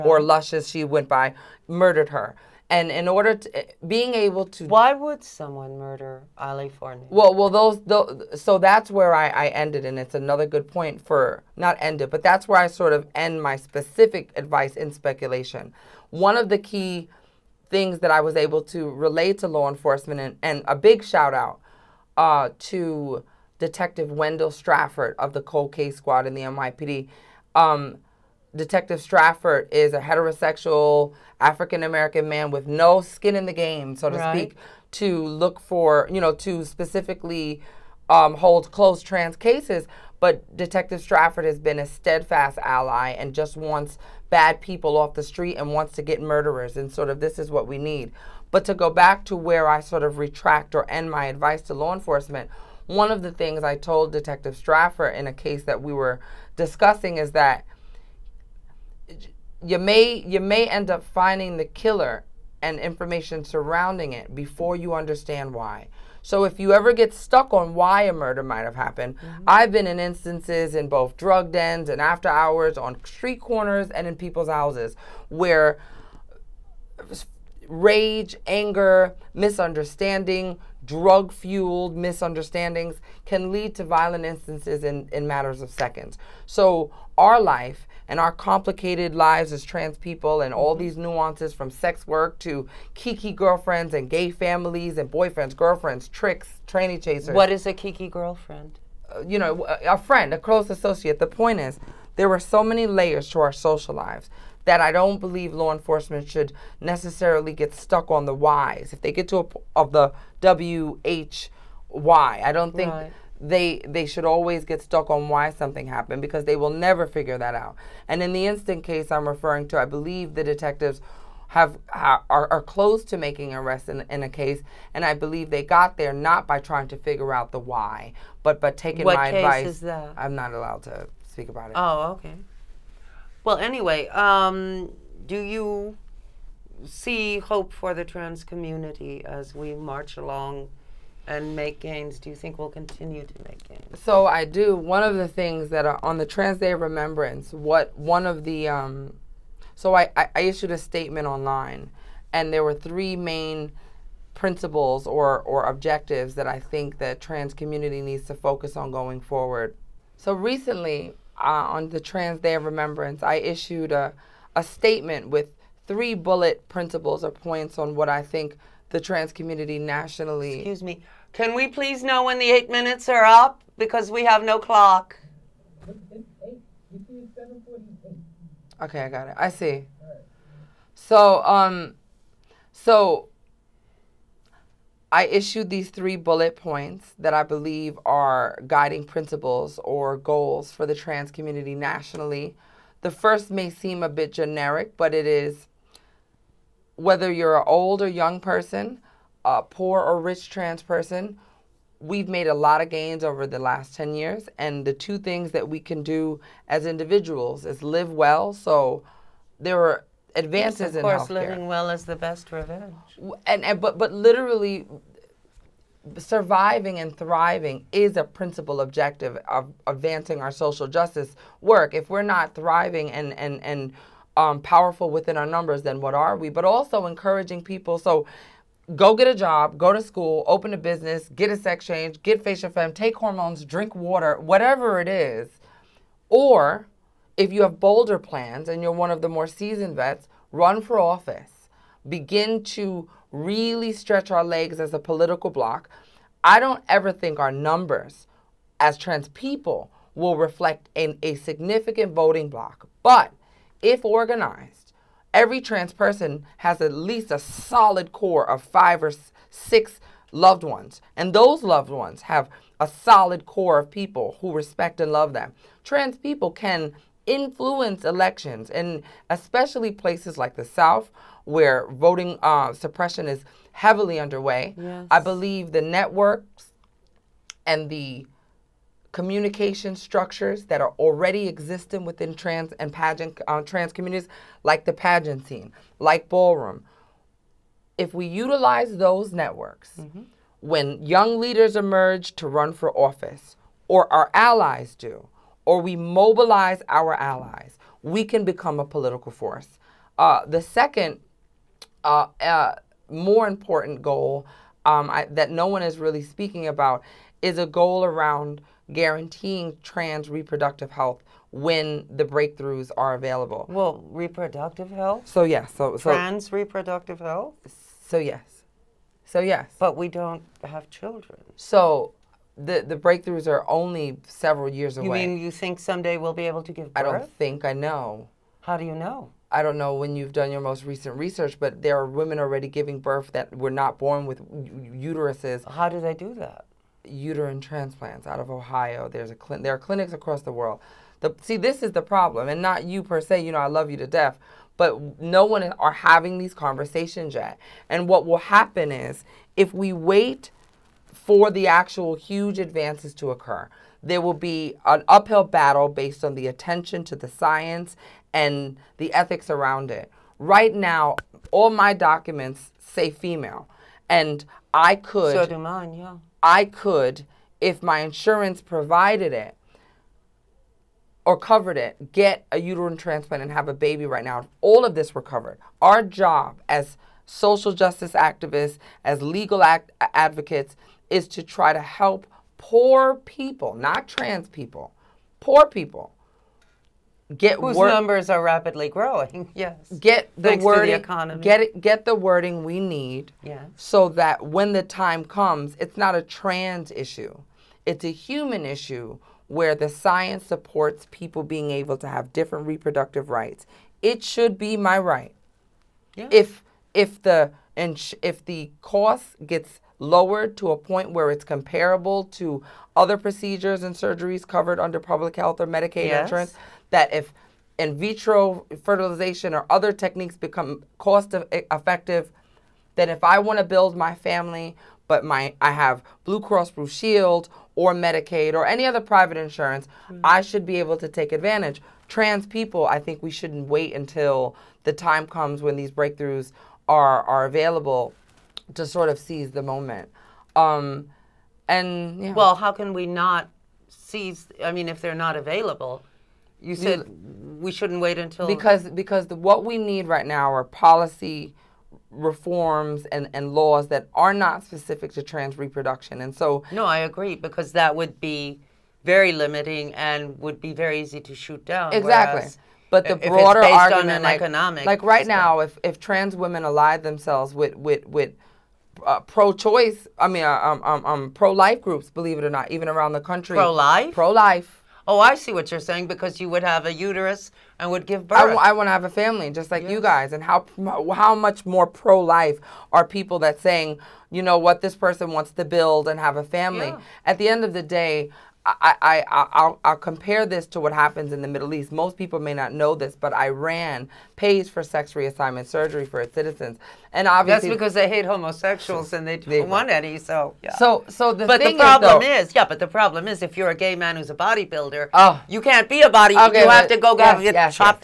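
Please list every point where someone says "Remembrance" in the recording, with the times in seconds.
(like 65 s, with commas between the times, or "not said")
146 s, 162 s.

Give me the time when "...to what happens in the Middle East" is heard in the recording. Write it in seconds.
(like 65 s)
490 s.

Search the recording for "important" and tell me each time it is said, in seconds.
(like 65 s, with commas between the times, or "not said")
303 s.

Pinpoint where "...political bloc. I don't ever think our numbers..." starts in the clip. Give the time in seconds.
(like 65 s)
244 s.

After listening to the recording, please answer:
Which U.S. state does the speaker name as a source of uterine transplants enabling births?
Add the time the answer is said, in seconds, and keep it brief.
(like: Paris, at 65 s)
Ohio, at 338 s.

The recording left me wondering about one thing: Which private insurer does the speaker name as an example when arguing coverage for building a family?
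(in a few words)
Blue Cross Blue Shield.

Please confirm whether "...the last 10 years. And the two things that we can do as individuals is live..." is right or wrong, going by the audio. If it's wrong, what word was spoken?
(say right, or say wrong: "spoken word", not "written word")
right.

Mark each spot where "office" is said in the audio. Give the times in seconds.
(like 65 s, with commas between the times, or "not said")
240 s, 293 s.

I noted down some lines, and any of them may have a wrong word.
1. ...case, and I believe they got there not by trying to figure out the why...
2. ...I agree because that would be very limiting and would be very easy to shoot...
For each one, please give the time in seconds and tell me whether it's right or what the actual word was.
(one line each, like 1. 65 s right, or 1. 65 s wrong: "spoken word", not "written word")
1. 124 s right
2. 456 s right.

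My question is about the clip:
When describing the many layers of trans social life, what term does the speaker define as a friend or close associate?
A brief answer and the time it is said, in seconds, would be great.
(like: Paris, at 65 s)
kiki girlfriend, at 92 s.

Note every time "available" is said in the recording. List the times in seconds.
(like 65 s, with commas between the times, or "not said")
313 s, 437 s, 445 s.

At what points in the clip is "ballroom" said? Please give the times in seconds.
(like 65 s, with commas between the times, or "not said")
286 s.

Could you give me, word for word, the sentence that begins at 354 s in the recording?
There will be an uphill battle based on the attention to the science and the ethics around it.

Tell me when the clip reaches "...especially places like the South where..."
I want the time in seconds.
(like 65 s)
269 s.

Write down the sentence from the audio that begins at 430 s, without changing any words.
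I should be able to take advantage.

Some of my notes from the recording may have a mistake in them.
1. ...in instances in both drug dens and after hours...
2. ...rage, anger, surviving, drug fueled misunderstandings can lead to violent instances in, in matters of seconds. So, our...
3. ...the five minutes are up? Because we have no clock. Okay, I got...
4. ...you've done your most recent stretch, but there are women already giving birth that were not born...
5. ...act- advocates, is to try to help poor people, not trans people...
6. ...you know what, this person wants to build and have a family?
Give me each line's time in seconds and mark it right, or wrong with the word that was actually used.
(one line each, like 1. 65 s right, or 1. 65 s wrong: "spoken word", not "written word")
1. 69 s right
2. 77 s wrong: "misunderstanding", not "surviving"
3. 172 s wrong: "eight", not "five"
4. 330 s wrong: "research", not "stretch"
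5. 379 s right
6. 484 s right.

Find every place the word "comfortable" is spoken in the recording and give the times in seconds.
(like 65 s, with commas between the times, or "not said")
not said.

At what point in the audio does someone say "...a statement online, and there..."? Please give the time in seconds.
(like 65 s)
150 s.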